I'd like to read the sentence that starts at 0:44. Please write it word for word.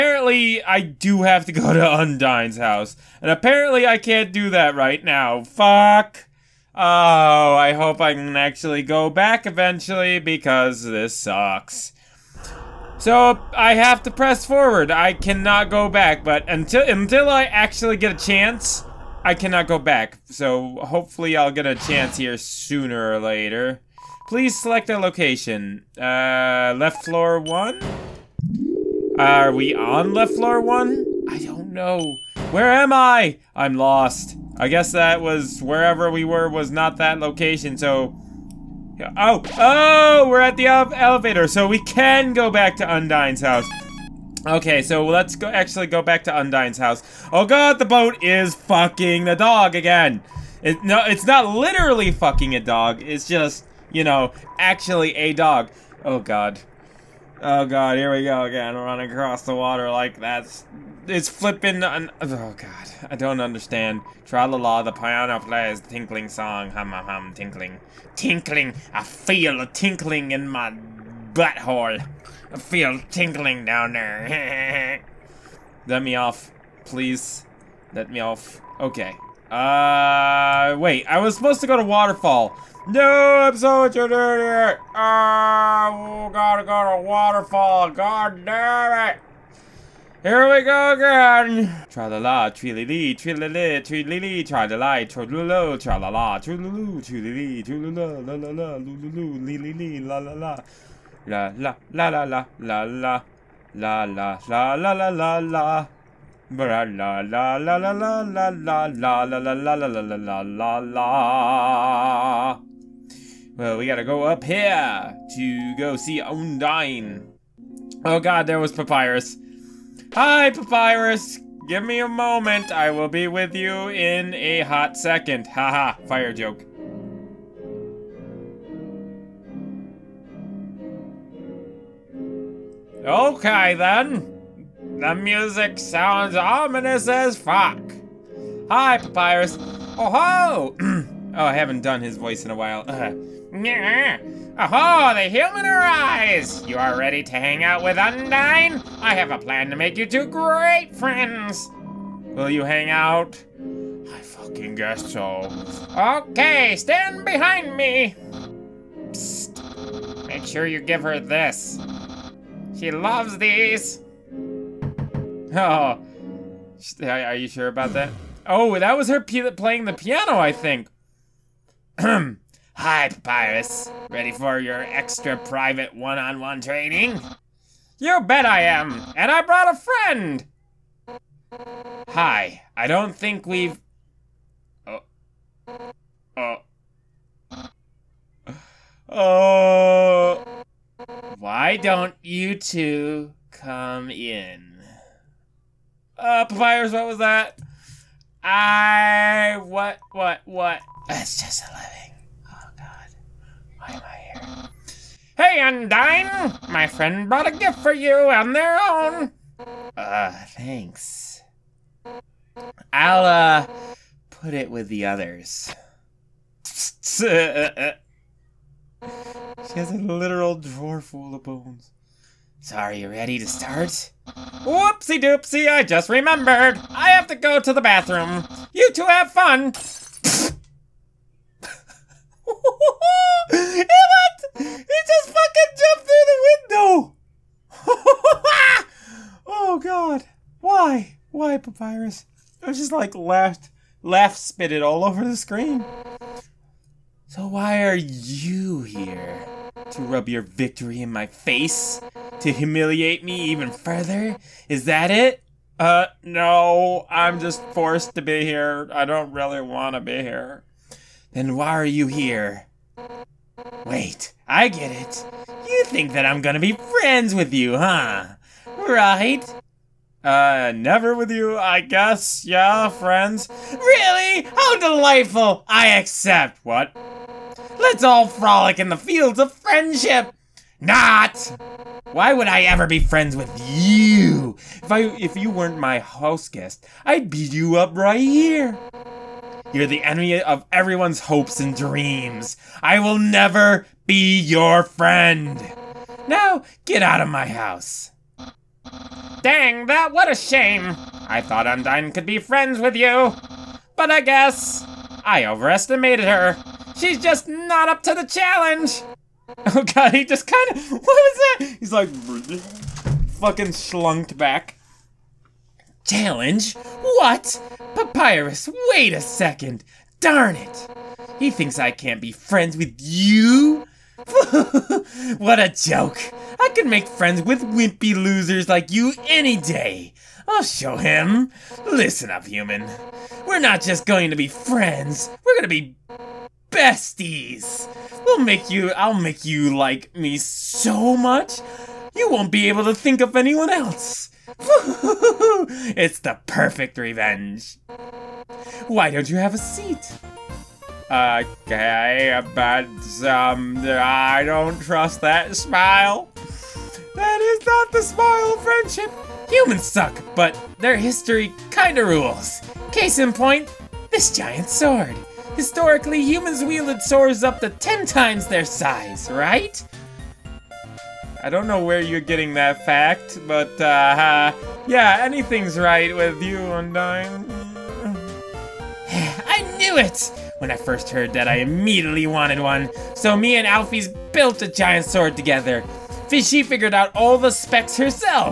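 Okay, so let's go actually go back to Undyne's house.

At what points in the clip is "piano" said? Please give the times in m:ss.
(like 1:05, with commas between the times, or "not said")
1:04, 2:49.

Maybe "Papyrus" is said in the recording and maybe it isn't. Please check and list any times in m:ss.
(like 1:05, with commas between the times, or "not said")
2:18, 2:52, 3:16, 4:01, 5:17.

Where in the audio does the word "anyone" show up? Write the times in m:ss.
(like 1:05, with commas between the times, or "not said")
5:43.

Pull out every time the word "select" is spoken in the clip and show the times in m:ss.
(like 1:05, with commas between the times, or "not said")
0:24.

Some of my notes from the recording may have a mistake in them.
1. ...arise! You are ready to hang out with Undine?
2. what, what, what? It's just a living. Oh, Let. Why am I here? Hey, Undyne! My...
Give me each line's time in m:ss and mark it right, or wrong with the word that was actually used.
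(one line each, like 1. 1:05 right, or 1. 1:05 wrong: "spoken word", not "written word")
1. 2:25 right
2. 3:19 wrong: "God", not "Let".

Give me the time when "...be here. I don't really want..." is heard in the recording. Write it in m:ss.
4:18.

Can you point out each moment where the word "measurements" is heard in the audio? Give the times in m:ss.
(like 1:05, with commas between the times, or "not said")
not said.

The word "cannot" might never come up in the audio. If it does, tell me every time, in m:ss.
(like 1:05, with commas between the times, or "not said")
0:15, 0:19.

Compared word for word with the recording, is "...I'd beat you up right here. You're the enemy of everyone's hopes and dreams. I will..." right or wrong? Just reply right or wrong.
right.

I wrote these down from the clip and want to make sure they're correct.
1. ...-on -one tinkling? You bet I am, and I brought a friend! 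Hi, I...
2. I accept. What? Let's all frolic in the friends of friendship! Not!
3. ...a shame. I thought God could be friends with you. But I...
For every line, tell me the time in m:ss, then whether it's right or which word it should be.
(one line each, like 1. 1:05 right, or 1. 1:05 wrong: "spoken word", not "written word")
1. 2:56 wrong: "training", not "tinkling"
2. 4:35 wrong: "fields", not "friends"
3. 5:00 wrong: "Undyne", not "God".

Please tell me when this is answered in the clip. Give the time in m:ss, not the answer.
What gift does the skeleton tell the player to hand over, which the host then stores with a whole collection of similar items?
3:41.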